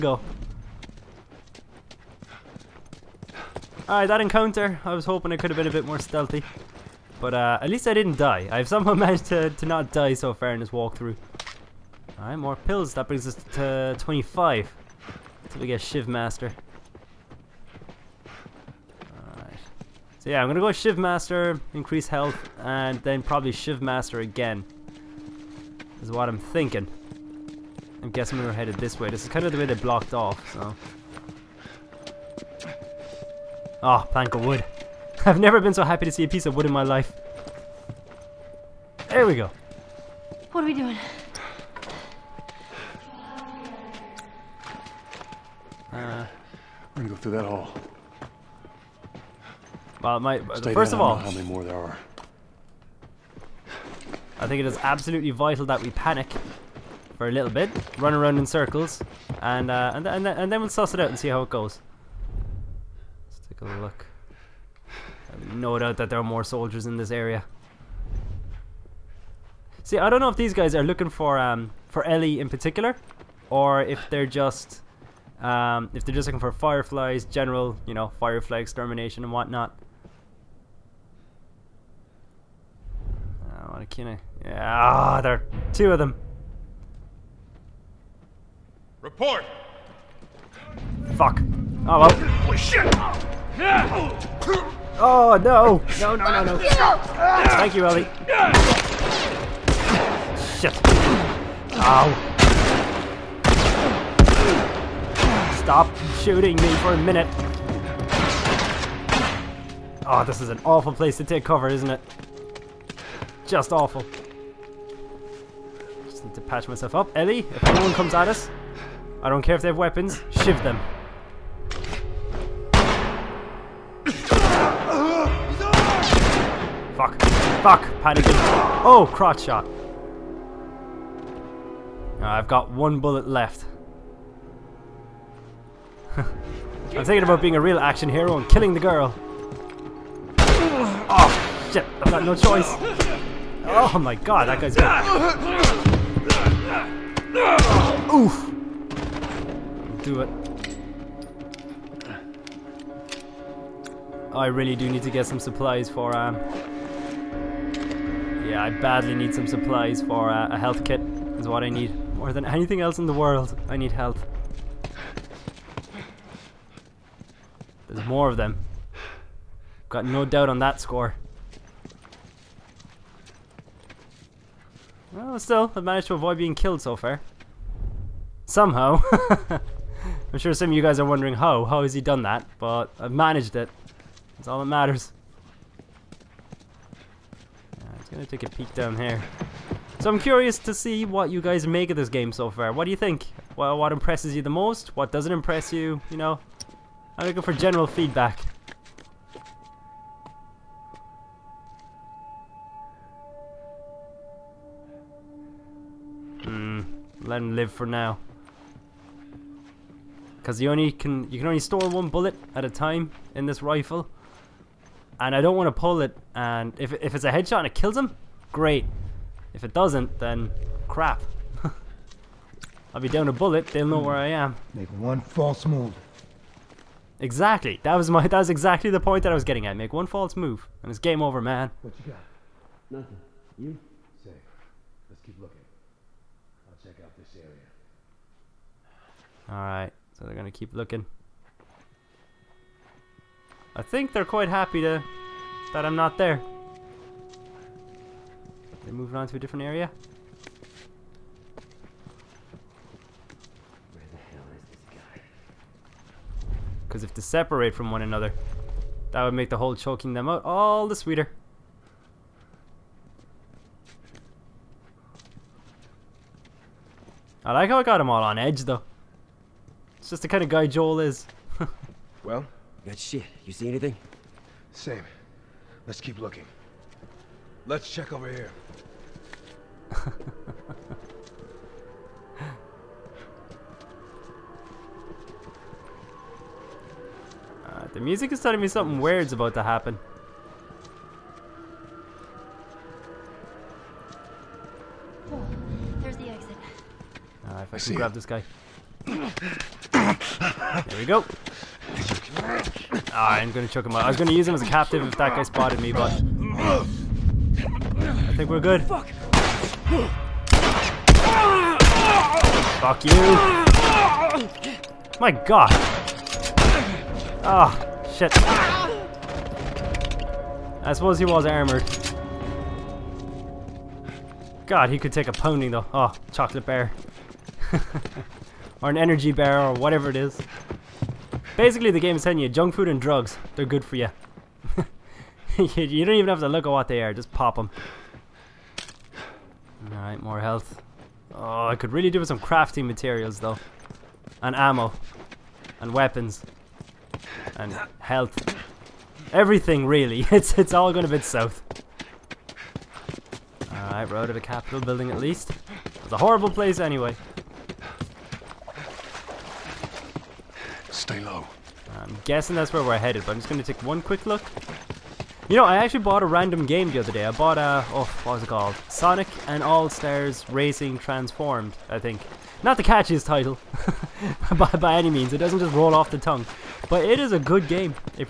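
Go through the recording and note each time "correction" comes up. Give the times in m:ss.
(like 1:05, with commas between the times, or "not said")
not said.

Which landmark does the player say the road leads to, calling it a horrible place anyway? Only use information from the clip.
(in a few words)
the Capitol building.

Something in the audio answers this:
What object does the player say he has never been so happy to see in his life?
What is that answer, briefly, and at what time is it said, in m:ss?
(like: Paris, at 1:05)
plank of wood, at 0:34.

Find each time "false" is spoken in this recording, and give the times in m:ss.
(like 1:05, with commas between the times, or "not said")
3:45, 3:50.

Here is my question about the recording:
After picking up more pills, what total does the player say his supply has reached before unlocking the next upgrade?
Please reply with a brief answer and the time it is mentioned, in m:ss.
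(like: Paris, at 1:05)
25, at 0:13.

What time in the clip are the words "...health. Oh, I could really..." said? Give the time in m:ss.
5:40.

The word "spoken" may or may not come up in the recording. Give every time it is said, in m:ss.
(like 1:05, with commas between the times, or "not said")
not said.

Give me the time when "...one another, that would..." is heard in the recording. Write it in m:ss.
4:17.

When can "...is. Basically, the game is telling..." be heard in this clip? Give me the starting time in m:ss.
5:30.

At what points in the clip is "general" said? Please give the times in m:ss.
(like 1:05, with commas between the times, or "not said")
1:17, 3:17.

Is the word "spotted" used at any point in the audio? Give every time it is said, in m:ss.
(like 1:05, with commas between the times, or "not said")
5:05.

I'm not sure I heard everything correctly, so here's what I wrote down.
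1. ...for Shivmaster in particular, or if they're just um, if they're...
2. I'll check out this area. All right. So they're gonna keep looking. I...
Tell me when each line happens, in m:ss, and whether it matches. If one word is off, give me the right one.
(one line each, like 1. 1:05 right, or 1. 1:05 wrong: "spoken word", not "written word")
1. 1:11 wrong: "Ellie", not "Shivmaster"
2. 3:56 right.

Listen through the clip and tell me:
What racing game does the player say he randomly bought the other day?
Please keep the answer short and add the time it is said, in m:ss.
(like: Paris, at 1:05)
Sonic and All-Stars Racing Transformed, at 6:08.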